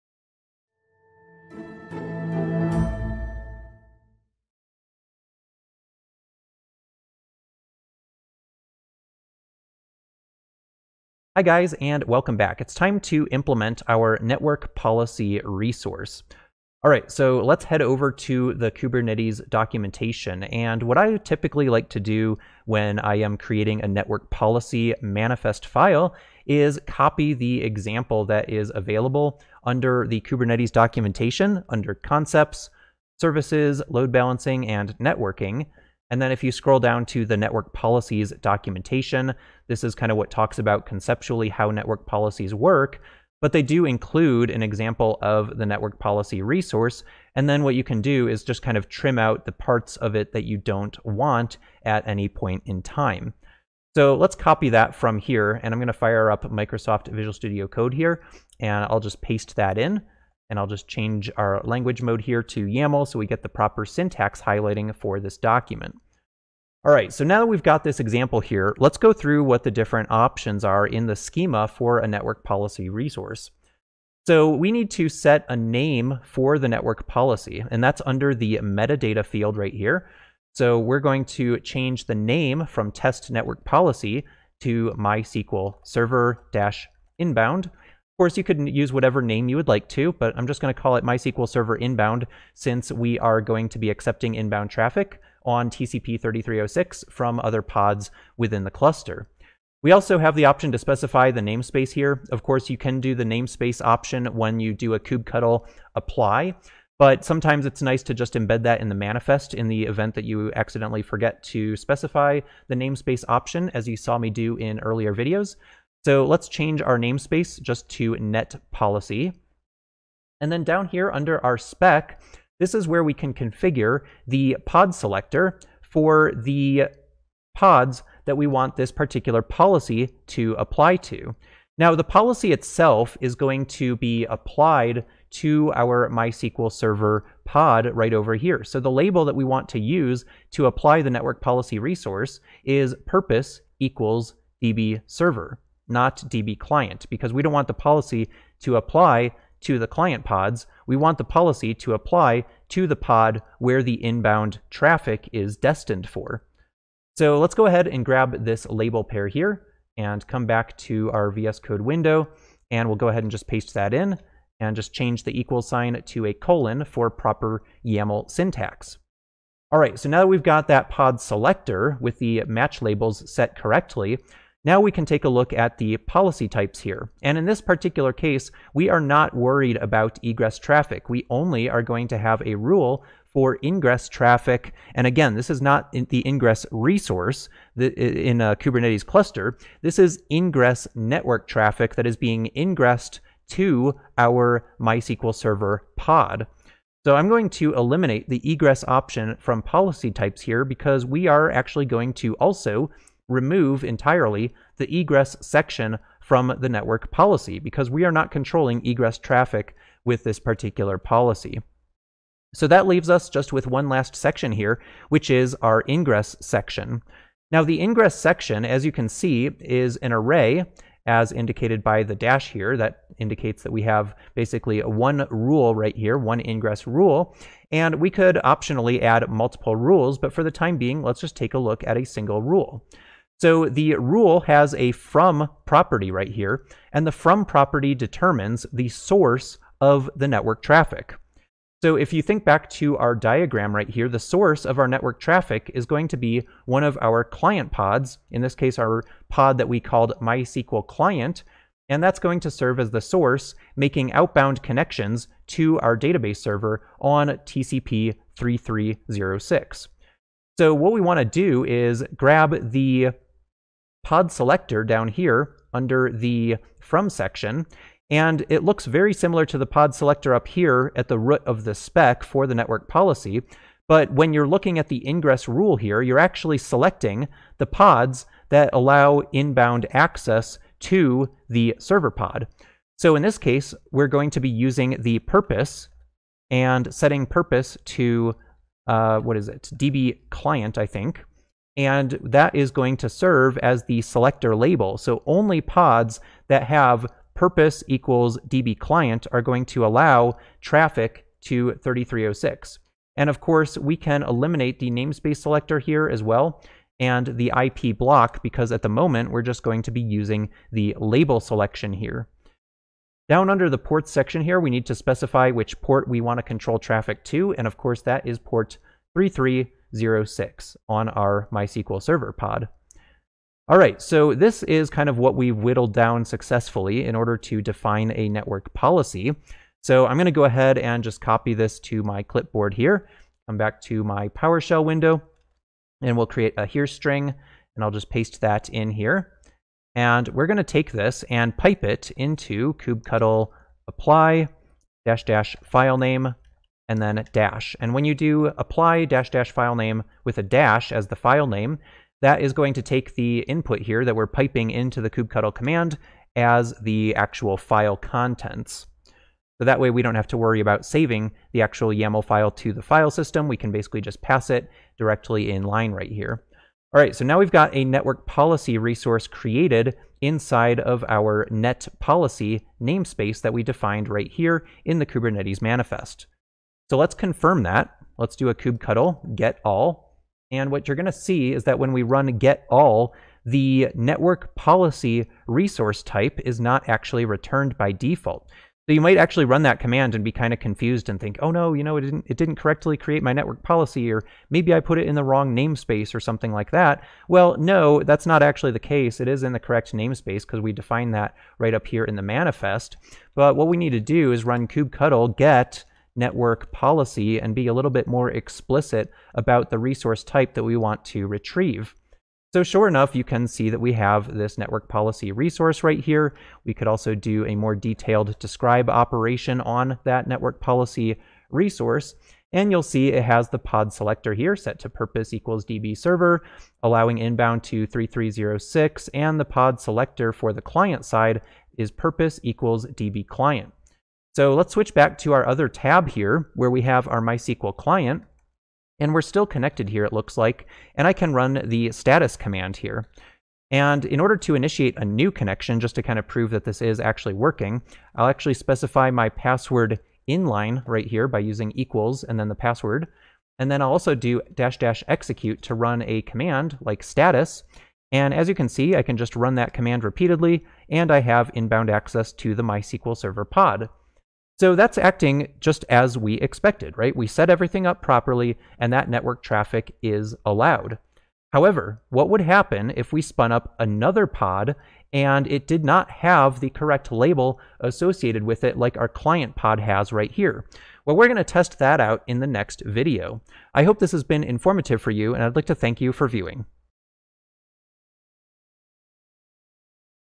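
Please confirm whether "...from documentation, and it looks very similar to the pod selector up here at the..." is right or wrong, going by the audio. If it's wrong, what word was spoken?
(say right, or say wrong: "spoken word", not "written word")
wrong: "section", not "documentation".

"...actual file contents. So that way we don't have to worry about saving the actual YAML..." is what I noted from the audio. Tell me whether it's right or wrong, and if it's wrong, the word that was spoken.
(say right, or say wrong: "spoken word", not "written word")
right.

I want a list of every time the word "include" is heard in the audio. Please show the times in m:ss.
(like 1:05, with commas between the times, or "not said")
0:43.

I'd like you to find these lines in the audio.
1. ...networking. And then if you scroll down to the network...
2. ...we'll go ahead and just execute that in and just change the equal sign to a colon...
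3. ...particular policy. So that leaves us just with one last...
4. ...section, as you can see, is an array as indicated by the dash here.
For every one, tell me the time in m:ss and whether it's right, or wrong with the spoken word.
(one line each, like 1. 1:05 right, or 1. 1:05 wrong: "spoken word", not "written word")
1. 0:34 right
2. 2:42 wrong: "paste", not "execute"
3. 3:30 right
4. 3:38 right.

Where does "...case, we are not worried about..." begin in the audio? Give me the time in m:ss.
2:58.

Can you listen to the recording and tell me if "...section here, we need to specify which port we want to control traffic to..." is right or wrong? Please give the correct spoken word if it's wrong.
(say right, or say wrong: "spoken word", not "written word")
right.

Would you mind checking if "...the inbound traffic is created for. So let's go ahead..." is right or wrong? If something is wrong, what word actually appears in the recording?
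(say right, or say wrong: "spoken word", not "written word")
wrong: "destined", not "created".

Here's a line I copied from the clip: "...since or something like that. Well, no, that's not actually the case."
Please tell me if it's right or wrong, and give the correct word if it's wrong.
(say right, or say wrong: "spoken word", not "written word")
wrong: "namespace", not "since".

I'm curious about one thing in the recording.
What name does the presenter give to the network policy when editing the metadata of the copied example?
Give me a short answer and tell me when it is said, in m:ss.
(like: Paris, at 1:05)
MySQL server inbound, at 1:24.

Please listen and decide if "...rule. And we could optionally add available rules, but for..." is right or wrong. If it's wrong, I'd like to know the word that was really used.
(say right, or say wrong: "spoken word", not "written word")
wrong: "multiple", not "available".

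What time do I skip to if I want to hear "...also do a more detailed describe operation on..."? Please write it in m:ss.
6:56.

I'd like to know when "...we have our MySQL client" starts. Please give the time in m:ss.
7:16.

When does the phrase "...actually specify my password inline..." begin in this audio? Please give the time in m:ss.
7:28.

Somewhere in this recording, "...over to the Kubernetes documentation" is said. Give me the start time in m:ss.
0:17.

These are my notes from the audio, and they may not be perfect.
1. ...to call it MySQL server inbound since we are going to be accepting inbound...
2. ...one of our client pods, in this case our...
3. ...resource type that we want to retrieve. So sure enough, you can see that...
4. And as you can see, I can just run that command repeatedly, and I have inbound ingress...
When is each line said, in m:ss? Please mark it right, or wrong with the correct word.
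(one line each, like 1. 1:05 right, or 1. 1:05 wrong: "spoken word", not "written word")
1. 1:30 right
2. 4:06 right
3. 6:49 right
4. 7:38 wrong: "access", not "ingress".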